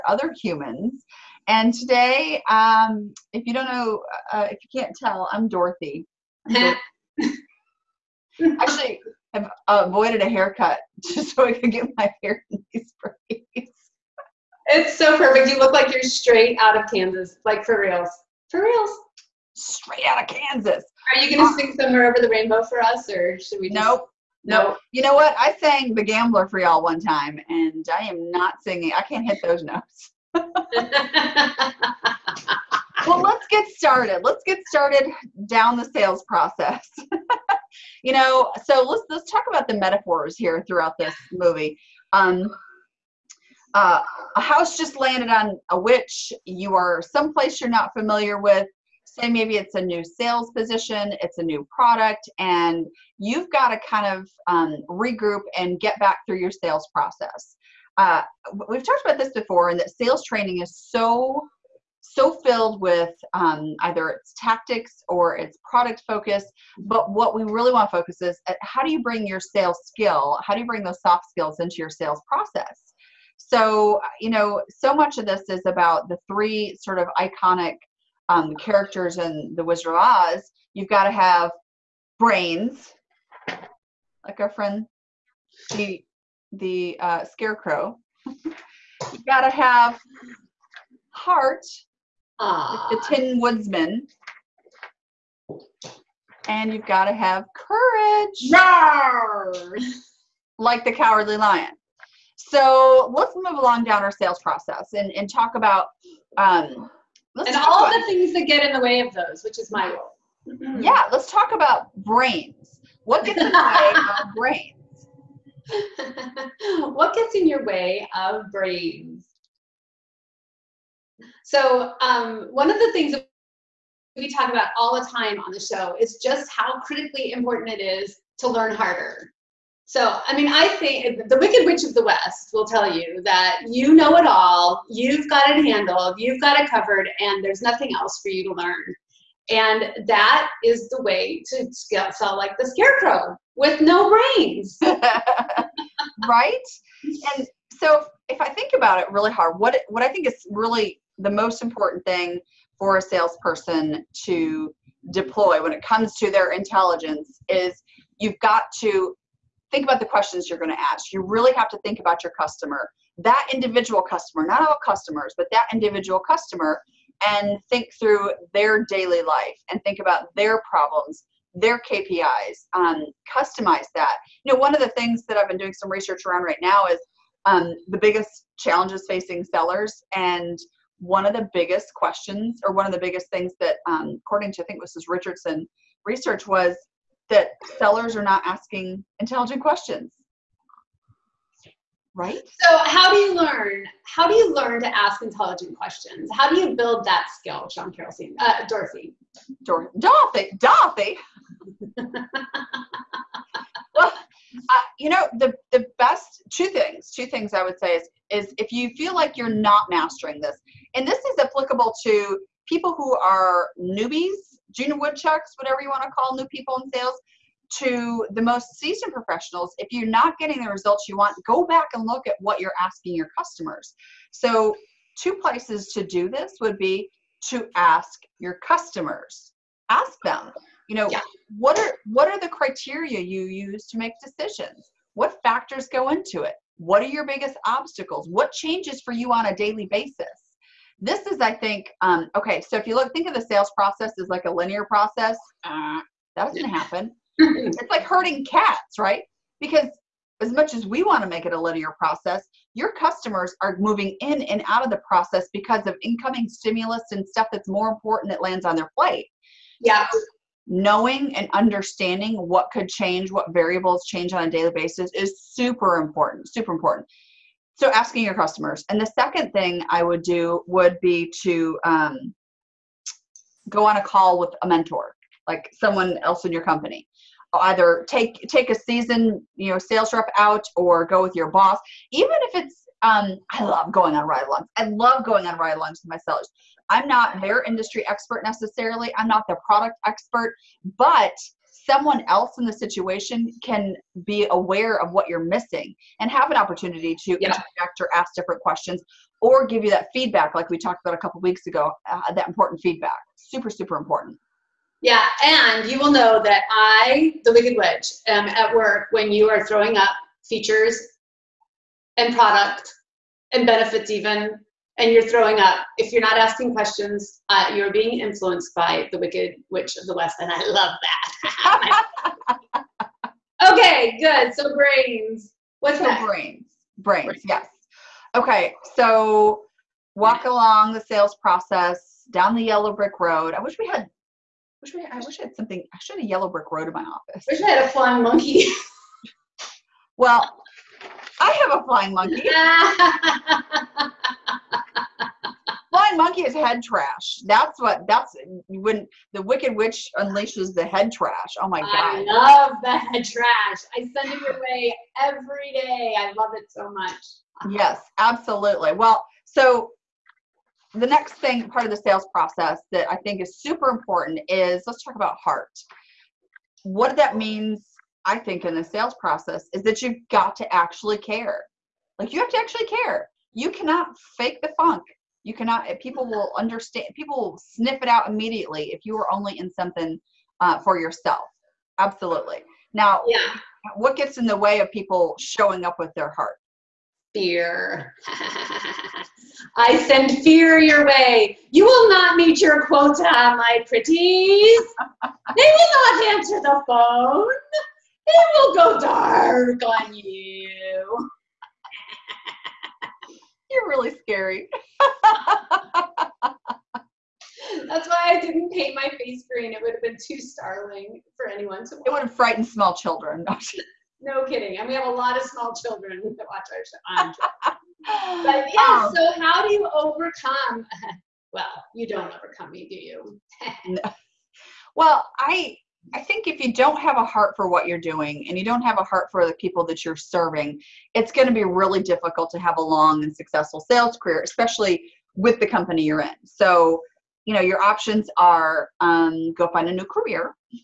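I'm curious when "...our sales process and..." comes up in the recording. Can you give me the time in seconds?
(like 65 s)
104 s.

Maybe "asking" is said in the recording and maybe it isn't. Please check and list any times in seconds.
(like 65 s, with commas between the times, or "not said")
188 s, 222 s, 267 s, 316 s.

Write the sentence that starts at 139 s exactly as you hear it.
And that is the way to sell like the scarecrow with no brains.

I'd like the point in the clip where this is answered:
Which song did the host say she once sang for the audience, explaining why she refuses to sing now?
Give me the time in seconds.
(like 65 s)
25 s.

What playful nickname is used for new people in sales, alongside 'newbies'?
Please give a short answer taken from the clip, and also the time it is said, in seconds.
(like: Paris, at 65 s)
junior woodchucks, at 214 s.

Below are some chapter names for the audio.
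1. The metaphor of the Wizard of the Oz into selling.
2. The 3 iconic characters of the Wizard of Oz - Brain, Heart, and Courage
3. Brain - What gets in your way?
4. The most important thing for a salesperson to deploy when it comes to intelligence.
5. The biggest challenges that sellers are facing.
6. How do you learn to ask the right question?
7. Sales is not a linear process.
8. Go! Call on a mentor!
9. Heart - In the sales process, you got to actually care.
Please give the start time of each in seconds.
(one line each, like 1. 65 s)
1. 32 s
2. 78 s
3. 107 s
4. 150 s
5. 177 s
6. 193 s
7. 245 s
8. 267 s
9. 363 s.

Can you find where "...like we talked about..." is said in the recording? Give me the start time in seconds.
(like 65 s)
300 s.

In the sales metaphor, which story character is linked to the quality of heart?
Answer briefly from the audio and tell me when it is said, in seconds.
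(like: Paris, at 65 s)
Tin Woodsman, at 93 s.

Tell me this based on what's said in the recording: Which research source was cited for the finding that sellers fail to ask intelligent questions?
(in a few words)
Richardson research.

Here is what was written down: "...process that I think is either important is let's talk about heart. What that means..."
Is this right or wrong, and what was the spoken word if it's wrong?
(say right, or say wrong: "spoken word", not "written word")
wrong: "super", not "either".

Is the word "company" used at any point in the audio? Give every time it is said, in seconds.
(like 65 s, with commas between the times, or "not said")
276 s, 435 s.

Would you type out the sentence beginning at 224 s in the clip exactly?
So, two places to do this would be to ask your customers, ask them, you know, yeah.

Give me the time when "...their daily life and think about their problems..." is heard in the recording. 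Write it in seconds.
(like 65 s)
168 s.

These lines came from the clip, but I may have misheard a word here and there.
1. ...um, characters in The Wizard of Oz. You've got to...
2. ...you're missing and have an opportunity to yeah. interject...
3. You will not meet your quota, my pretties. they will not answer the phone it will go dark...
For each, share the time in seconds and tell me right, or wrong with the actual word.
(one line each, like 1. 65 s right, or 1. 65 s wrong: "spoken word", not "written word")
1. 78 s right
2. 295 s right
3. 391 s right.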